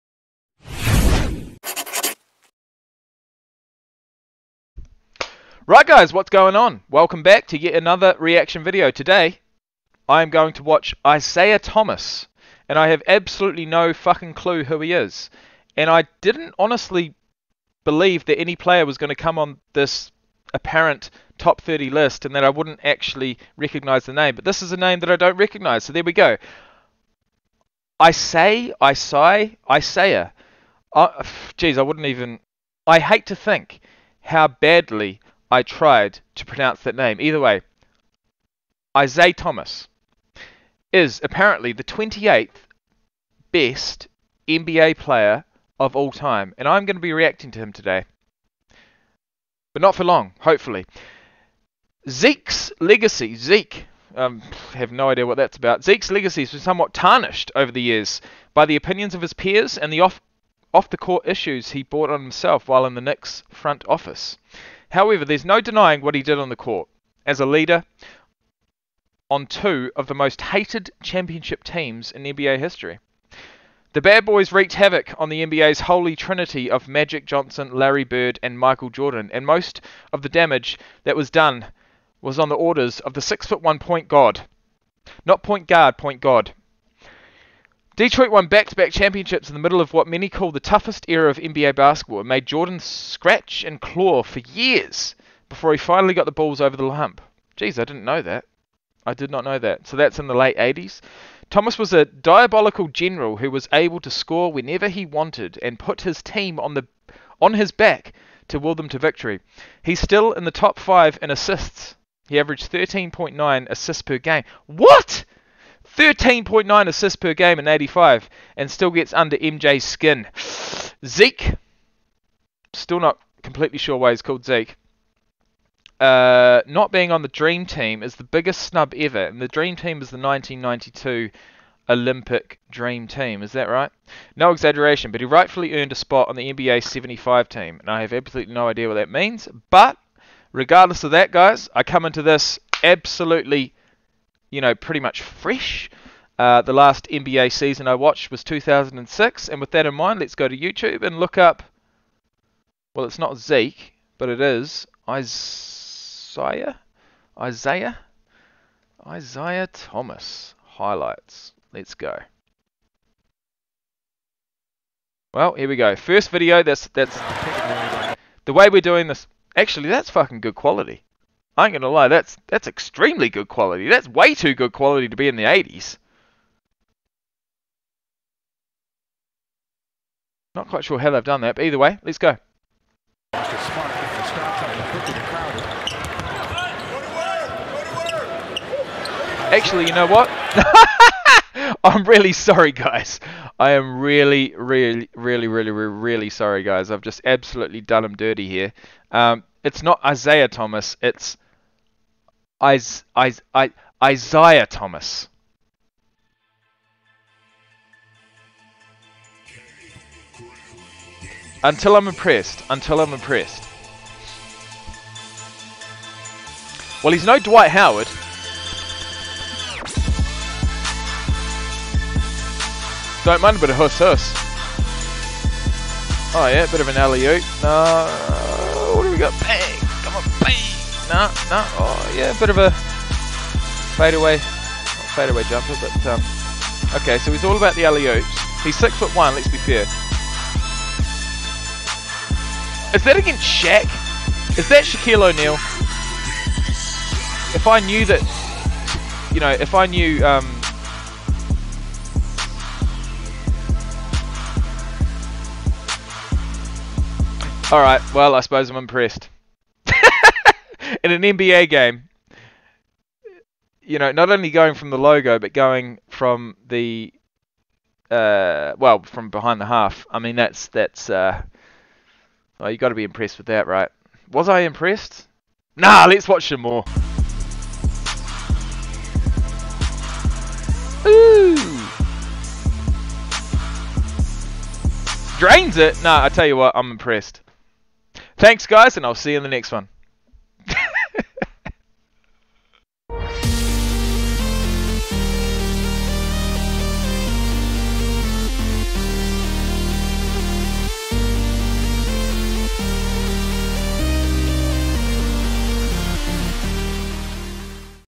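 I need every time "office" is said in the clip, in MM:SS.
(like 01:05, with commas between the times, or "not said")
01:03.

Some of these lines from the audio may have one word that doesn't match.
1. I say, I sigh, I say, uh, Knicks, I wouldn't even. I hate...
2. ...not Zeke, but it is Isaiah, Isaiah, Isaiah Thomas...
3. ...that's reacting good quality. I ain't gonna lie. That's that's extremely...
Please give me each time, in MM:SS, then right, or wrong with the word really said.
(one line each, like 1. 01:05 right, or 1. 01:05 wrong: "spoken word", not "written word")
1. 00:27 wrong: "Jeez", not "Knicks"
2. 02:33 right
3. 02:49 wrong: "fucking", not "reacting".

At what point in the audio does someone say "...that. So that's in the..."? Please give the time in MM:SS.
01:39.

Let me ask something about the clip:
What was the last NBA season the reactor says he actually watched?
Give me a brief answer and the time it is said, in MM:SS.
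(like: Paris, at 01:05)
2006, at 02:28.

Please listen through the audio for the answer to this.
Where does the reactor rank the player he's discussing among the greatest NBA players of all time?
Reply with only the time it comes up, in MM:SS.
00:41.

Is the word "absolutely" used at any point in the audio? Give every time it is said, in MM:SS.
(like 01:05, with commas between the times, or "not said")
00:13, 02:18, 02:22, 03:17.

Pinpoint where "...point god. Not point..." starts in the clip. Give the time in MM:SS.
01:23.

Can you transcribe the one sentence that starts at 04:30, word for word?
I mean, that's, that's, uh, Oh, you got to be impressed with that, right?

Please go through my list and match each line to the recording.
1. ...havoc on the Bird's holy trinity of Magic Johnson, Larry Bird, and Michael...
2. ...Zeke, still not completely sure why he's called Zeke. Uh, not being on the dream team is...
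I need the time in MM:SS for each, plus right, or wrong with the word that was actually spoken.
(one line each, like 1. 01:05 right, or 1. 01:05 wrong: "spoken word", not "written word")
1. 01:14 wrong: "NBA", not "Bird"
2. 02:01 right.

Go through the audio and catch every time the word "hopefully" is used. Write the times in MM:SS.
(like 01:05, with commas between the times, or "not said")
00:50.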